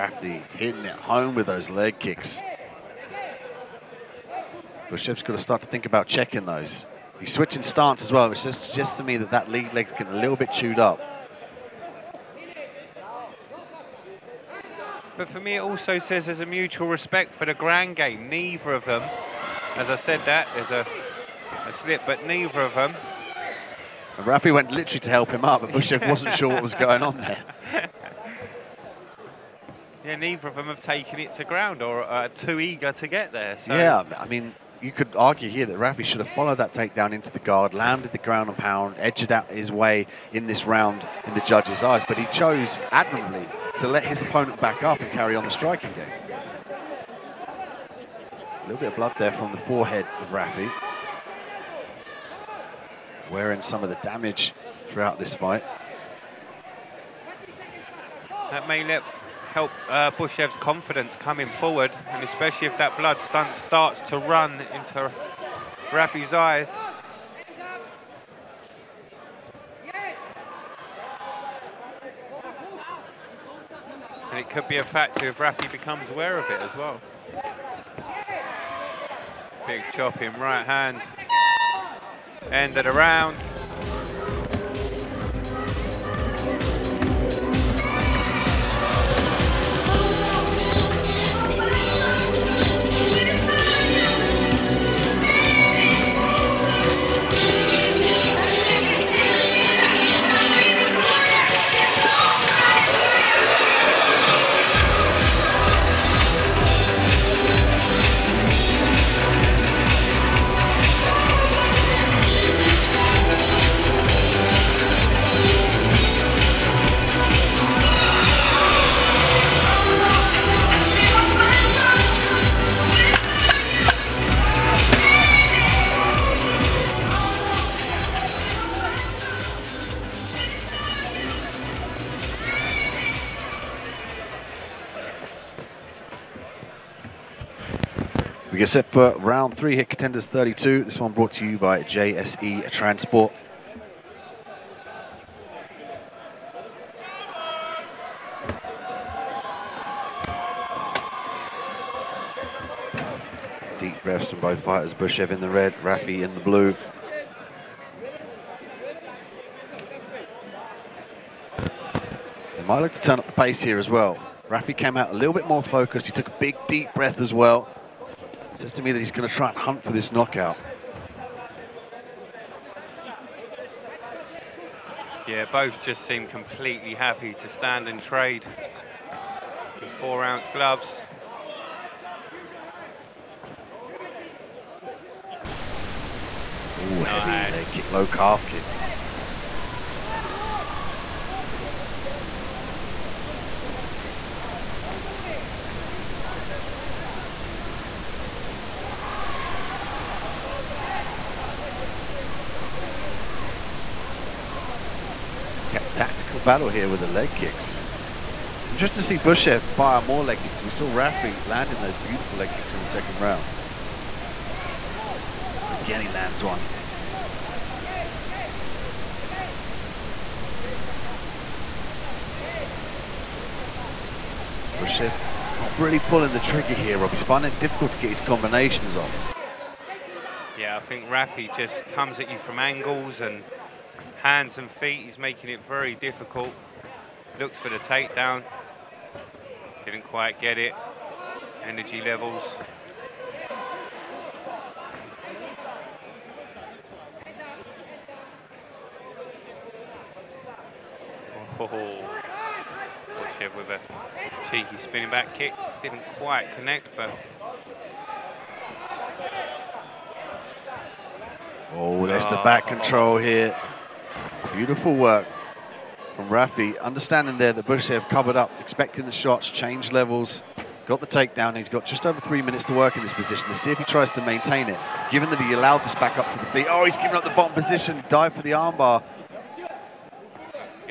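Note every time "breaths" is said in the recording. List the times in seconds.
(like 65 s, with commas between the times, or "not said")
154 s, 166 s.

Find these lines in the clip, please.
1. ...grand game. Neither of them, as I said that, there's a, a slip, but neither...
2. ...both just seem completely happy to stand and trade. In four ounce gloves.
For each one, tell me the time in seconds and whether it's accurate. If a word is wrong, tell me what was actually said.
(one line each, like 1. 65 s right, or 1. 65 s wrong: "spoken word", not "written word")
1. 17 s right
2. 175 s right.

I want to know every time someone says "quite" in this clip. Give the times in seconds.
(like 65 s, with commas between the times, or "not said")
240 s, 256 s.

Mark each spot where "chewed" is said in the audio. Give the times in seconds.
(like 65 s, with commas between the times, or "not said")
10 s.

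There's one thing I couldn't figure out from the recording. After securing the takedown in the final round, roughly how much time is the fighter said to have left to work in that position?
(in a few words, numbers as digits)
just over 3 minutes.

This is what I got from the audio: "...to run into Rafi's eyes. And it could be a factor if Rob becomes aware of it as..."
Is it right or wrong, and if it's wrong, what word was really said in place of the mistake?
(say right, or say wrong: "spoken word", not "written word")
wrong: "Rafi", not "Rob".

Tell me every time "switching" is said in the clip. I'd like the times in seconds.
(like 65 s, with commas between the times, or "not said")
7 s.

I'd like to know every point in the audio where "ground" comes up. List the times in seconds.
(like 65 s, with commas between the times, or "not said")
31 s, 38 s.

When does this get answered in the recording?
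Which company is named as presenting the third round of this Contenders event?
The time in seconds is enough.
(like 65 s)
141 s.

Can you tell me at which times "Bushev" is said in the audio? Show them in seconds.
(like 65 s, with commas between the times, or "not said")
4 s, 25 s, 60 s, 154 s, 209 s, 224 s, 253 s.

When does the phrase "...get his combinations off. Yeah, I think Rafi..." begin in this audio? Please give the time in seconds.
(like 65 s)
227 s.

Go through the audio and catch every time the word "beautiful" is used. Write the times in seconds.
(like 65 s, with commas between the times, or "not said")
211 s, 264 s.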